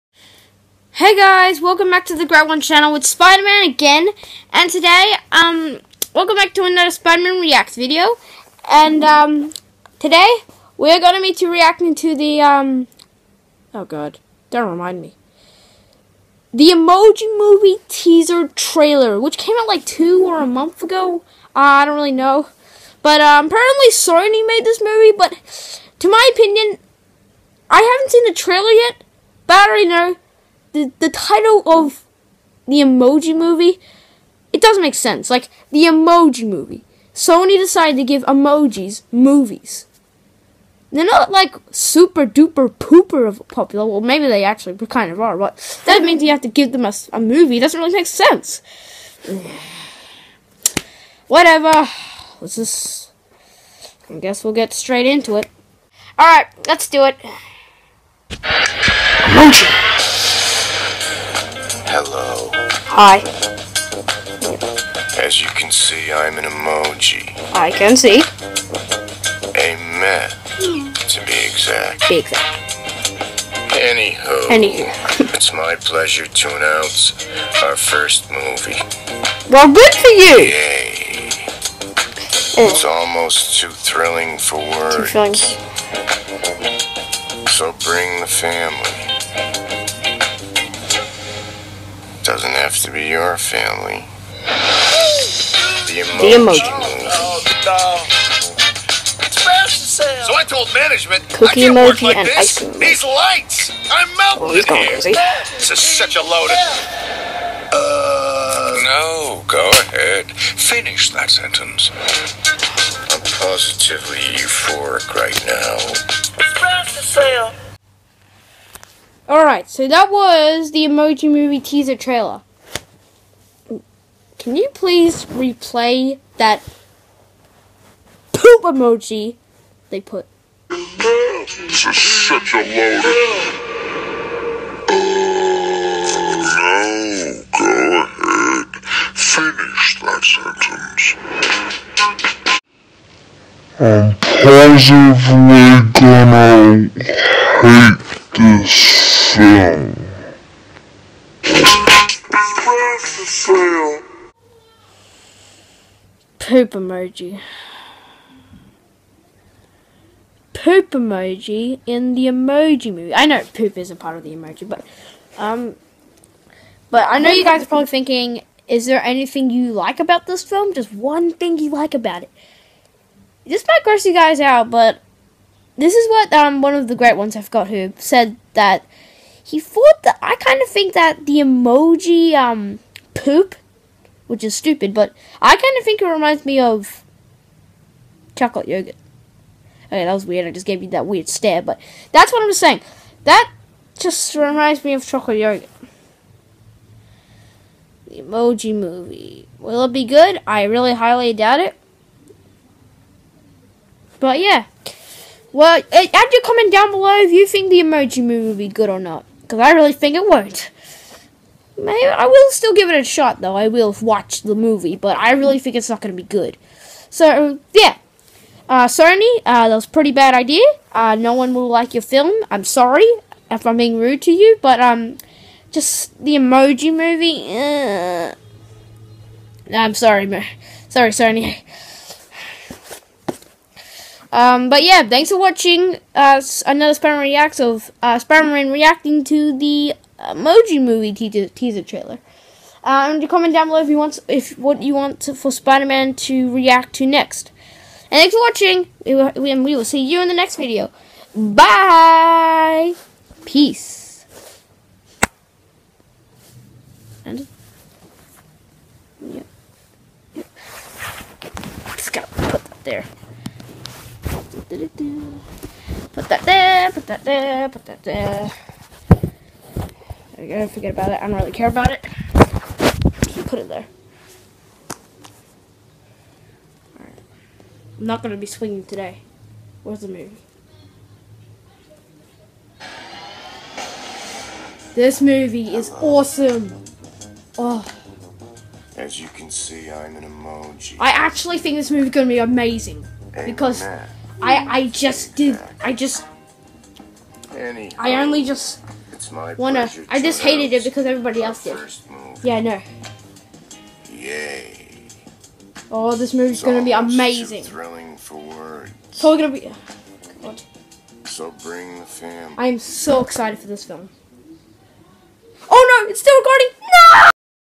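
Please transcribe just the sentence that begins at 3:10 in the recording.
I just gave you that weird stare, but that's what I'm saying.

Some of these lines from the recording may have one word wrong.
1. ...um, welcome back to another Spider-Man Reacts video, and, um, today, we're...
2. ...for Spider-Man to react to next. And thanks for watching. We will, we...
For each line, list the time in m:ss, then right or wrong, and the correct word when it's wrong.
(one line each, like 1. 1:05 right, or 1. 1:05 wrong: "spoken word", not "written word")
1. 0:05 right
2. 4:05 right.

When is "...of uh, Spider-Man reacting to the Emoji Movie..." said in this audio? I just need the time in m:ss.
3:57.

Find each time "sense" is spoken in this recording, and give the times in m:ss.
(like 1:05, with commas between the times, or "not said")
0:34, 0:48.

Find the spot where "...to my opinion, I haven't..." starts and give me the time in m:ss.
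0:25.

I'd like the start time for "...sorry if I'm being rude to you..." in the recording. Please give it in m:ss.
3:42.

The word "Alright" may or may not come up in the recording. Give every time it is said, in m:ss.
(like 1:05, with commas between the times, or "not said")
0:56, 1:59, 4:36.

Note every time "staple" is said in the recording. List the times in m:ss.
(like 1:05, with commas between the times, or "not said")
not said.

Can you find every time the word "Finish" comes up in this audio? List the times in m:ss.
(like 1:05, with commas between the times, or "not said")
1:50, 2:19.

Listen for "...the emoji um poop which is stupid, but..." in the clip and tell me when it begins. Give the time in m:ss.
3:01.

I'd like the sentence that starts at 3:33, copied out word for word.
I will watch the movie, but I really think it's not going to be good.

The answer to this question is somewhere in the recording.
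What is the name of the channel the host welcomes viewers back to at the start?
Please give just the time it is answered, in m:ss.
0:02.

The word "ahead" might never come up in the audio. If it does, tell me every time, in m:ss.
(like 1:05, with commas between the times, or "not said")
1:49, 2:18.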